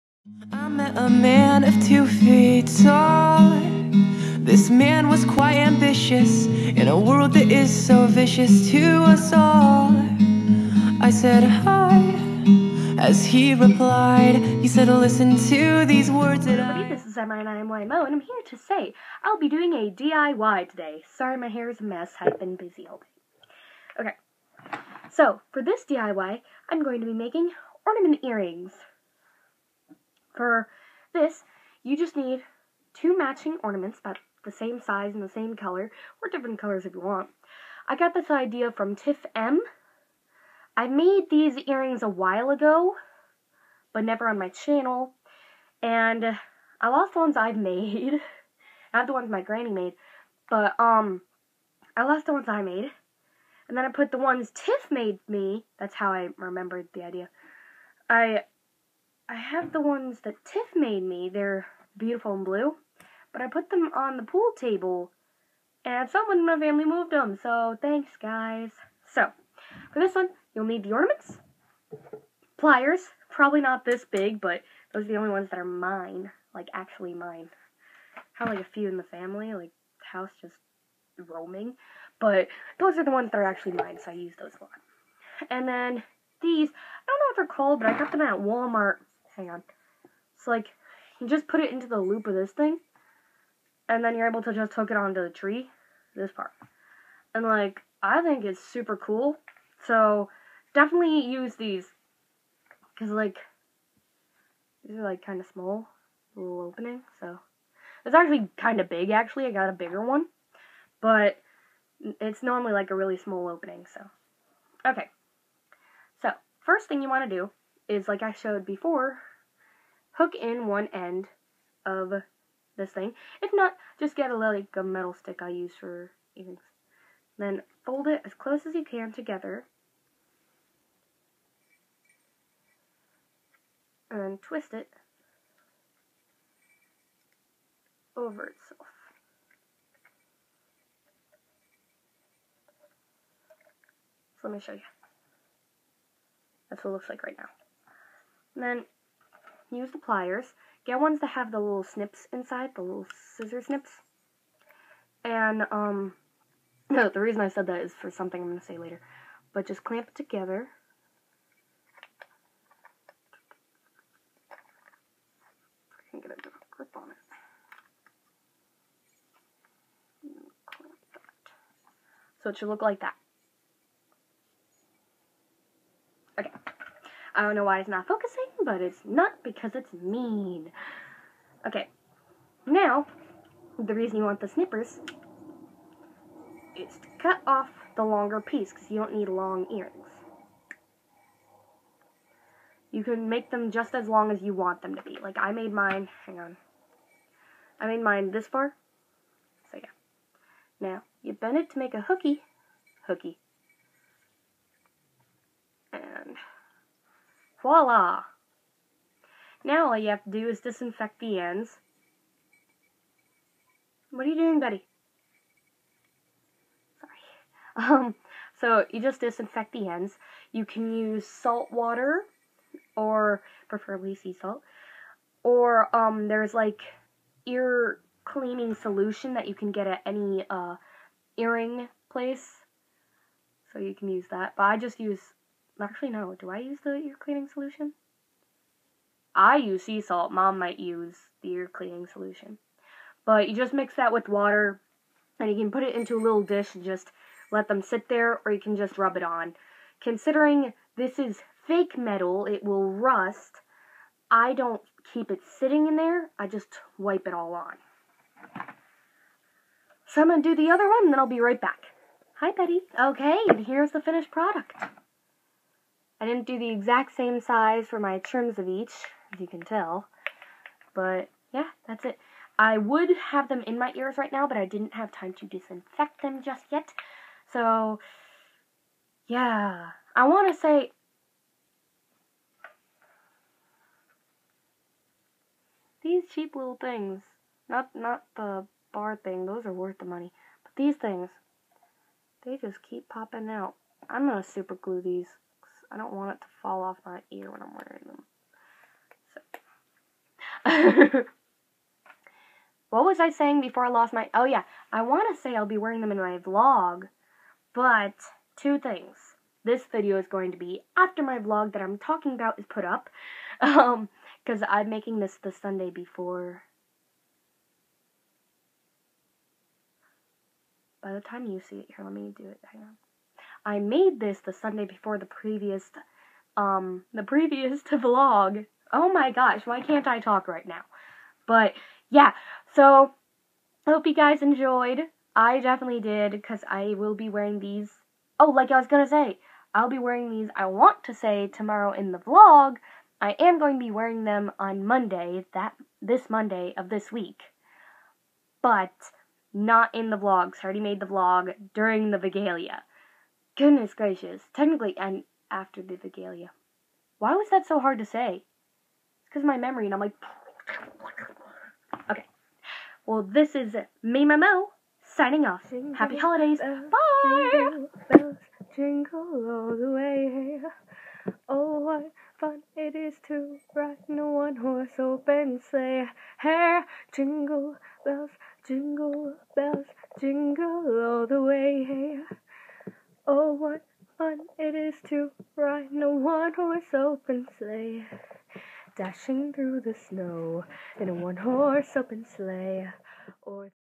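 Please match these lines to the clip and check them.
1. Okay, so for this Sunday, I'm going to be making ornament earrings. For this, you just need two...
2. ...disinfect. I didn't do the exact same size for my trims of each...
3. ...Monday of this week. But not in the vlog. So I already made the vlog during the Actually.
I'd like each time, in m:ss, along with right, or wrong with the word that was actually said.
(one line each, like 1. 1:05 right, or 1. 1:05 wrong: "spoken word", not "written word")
1. 0:24 wrong: "DIY", not "Sunday"
2. 4:24 wrong: "product", not "disinfect"
3. 5:46 wrong: "Vigalia", not "Actually".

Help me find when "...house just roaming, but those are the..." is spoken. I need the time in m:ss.
1:20.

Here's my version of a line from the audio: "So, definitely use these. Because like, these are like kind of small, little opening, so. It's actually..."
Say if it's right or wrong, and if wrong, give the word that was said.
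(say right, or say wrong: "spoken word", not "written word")
right.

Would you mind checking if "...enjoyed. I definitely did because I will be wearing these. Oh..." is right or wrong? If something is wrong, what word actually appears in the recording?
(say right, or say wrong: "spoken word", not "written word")
right.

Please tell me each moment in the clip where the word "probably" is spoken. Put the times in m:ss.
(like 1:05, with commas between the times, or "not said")
1:13.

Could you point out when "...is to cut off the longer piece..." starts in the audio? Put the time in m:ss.
3:06.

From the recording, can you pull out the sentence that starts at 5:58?
It's because my memory and I'm like...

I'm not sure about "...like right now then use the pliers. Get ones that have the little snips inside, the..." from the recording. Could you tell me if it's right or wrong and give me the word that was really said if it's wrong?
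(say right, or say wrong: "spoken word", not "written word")
right.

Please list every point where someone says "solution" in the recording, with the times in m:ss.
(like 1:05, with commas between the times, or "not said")
3:48, 3:57, 4:02.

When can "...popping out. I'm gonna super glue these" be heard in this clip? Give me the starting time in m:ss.
4:53.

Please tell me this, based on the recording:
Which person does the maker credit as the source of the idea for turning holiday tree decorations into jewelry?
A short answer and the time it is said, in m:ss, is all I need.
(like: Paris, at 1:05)
Tiff M, at 0:38.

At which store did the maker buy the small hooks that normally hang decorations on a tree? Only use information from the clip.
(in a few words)
Walmart.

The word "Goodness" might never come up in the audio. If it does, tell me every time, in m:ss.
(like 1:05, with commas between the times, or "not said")
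5:53.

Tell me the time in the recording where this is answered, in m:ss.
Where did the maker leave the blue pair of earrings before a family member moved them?
1:04.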